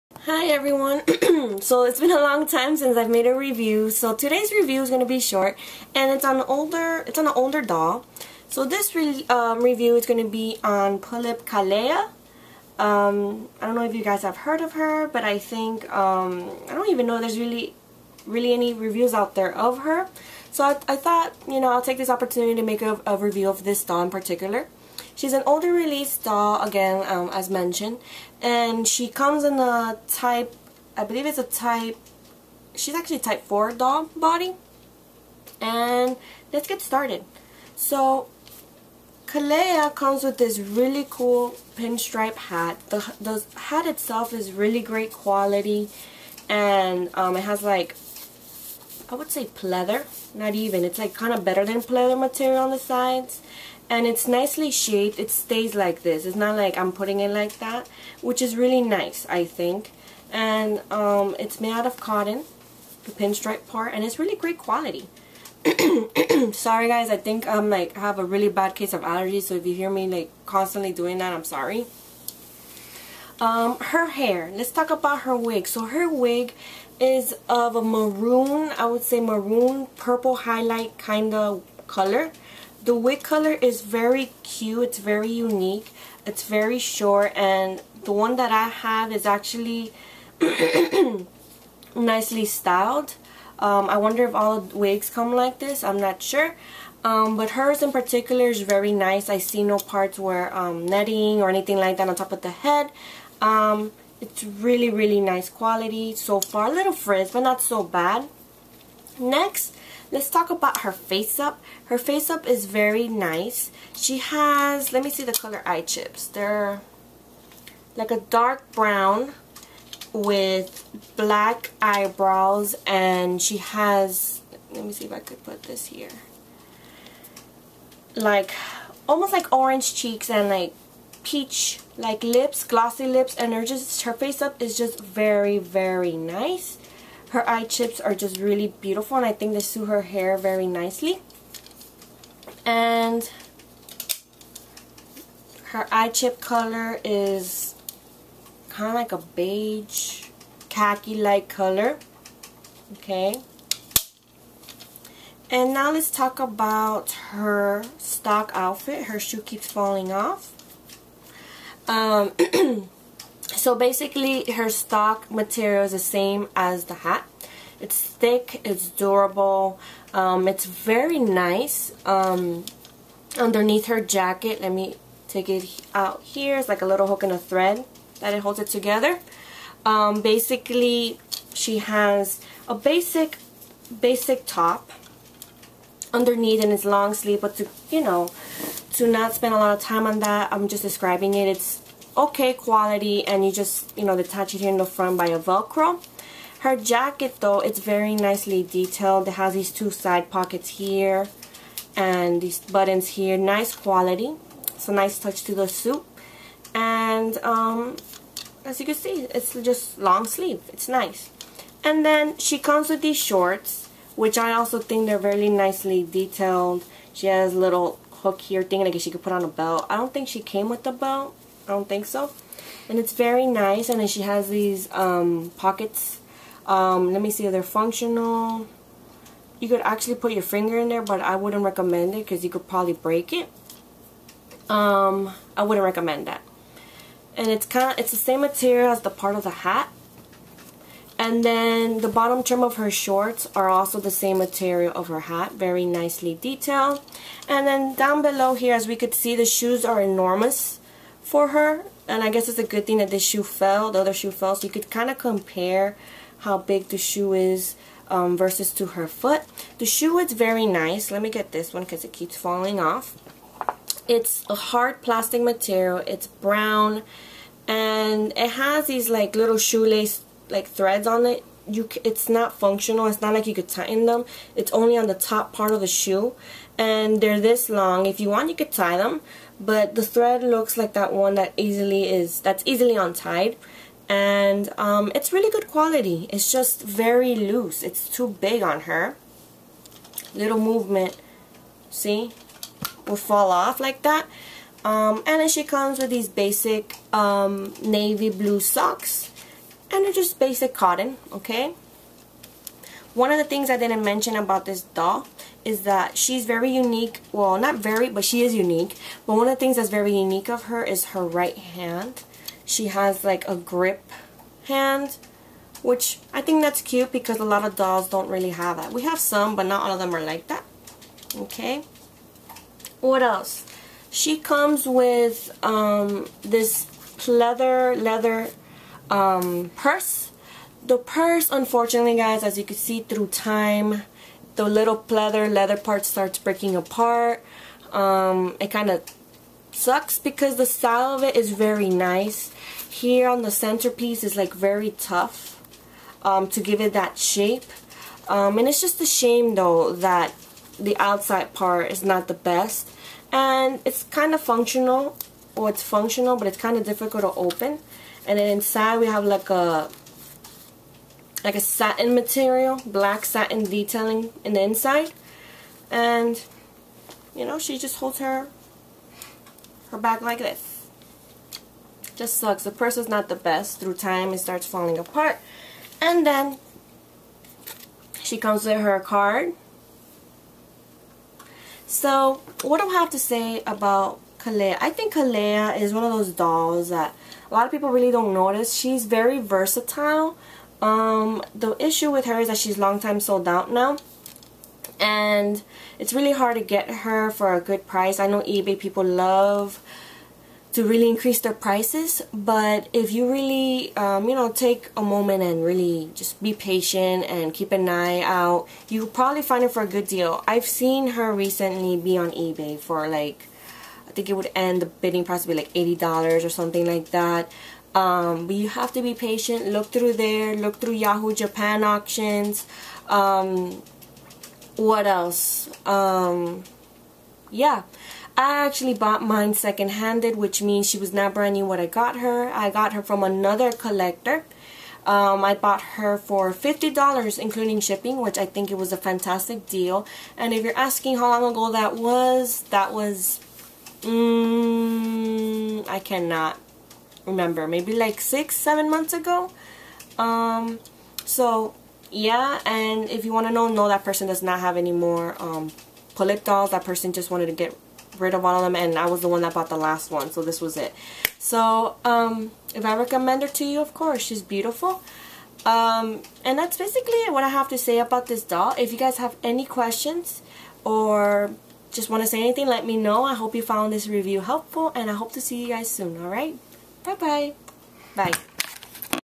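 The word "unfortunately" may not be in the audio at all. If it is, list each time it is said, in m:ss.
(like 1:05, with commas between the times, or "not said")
5:31.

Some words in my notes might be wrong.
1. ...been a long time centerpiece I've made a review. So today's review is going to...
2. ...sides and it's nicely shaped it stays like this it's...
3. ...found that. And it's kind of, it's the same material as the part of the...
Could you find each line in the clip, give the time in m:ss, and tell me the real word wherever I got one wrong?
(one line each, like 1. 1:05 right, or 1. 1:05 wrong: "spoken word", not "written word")
1. 0:01 wrong: "since", not "centerpiece"
2. 0:52 right
3. 3:55 wrong: "recommend", not "found".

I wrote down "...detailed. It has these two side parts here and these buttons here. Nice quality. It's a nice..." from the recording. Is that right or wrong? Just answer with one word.
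wrong.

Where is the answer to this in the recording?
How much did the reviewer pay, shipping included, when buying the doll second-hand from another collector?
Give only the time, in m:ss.
7:16.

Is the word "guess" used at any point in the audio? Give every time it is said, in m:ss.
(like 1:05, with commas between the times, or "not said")
3:38, 4:12.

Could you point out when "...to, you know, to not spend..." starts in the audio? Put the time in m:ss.
3:07.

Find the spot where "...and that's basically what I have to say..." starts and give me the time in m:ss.
7:46.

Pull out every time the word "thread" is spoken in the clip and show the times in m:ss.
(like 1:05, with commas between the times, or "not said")
2:57, 4:30, 4:40.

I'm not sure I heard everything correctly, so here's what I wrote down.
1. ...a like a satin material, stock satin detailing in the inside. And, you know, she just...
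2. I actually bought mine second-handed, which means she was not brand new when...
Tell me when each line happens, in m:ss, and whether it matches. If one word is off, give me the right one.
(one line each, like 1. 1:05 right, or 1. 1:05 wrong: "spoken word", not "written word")
1. 5:59 wrong: "black", not "stock"
2. 7:08 right.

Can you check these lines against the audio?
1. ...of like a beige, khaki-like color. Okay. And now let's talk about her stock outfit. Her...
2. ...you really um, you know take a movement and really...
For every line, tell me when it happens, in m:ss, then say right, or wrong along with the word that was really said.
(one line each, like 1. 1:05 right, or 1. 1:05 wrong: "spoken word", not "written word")
1. 2:28 right
2. 6:43 wrong: "moment", not "movement".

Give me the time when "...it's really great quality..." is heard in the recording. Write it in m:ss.
1:04.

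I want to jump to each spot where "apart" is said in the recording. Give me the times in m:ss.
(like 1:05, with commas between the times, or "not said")
5:36, 6:14.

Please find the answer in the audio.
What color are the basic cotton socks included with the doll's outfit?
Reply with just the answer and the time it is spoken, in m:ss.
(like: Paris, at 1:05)
navy blue, at 4:57.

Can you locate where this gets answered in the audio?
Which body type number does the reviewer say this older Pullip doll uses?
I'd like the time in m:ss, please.
0:33.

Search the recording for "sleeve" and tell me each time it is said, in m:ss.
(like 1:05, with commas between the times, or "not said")
3:07, 3:30.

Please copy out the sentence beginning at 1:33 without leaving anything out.
Um, I wonder if all wigs come like this, I'm not sure.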